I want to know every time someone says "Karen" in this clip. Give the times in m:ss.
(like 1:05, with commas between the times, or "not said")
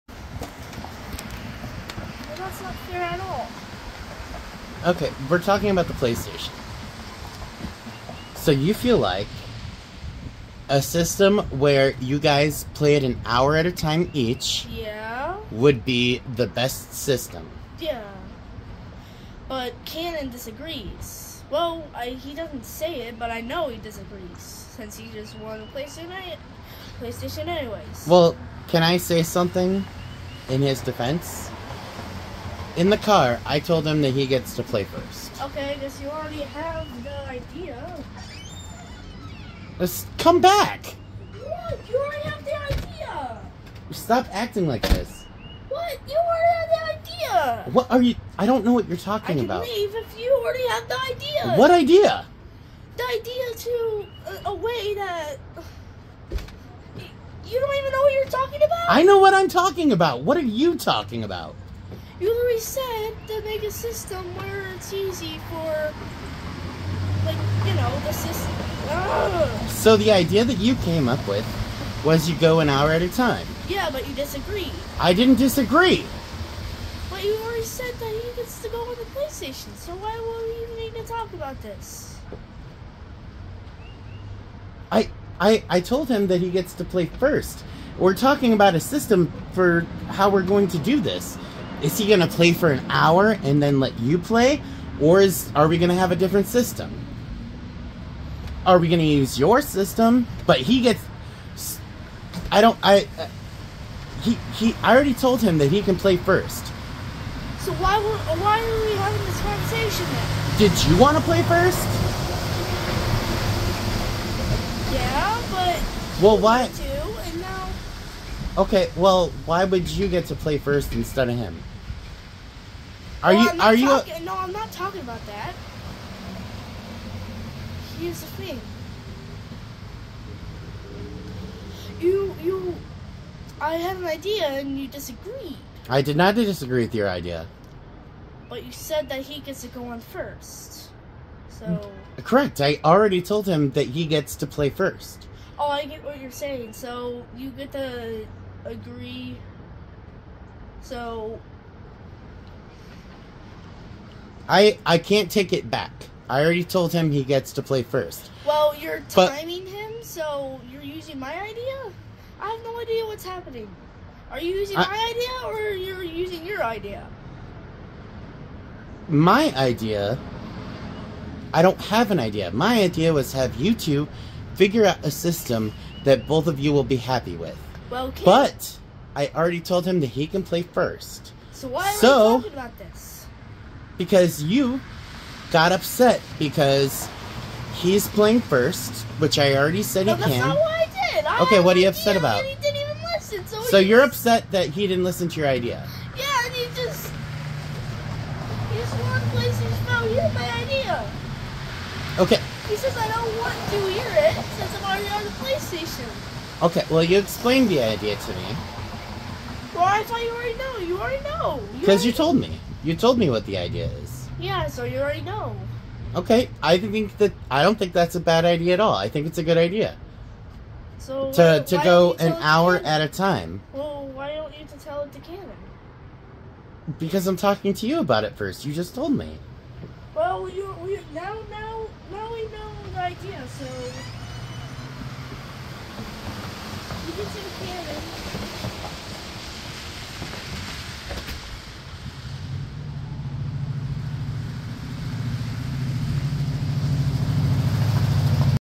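3:45, 3:58.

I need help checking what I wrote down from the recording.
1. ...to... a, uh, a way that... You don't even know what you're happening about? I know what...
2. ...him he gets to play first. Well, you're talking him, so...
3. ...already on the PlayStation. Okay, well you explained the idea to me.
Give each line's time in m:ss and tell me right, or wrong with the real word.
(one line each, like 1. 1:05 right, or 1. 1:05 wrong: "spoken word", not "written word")
1. 0:53 wrong: "talking", not "happening"
2. 2:36 wrong: "timing", not "talking"
3. 3:24 right.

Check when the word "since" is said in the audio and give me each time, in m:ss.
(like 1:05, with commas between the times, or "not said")
0:24, 3:24.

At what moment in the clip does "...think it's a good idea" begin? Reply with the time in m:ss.
3:39.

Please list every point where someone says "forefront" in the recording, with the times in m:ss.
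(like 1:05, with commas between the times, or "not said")
not said.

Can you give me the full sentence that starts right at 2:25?
Oh, I get what you're saying.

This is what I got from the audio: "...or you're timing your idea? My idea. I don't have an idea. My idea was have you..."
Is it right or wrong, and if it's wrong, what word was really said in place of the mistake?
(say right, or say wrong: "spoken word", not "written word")
wrong: "using", not "timing".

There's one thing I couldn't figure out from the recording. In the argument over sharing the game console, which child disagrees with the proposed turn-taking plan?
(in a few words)
Cannon.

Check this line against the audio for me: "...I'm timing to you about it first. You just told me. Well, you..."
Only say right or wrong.
wrong.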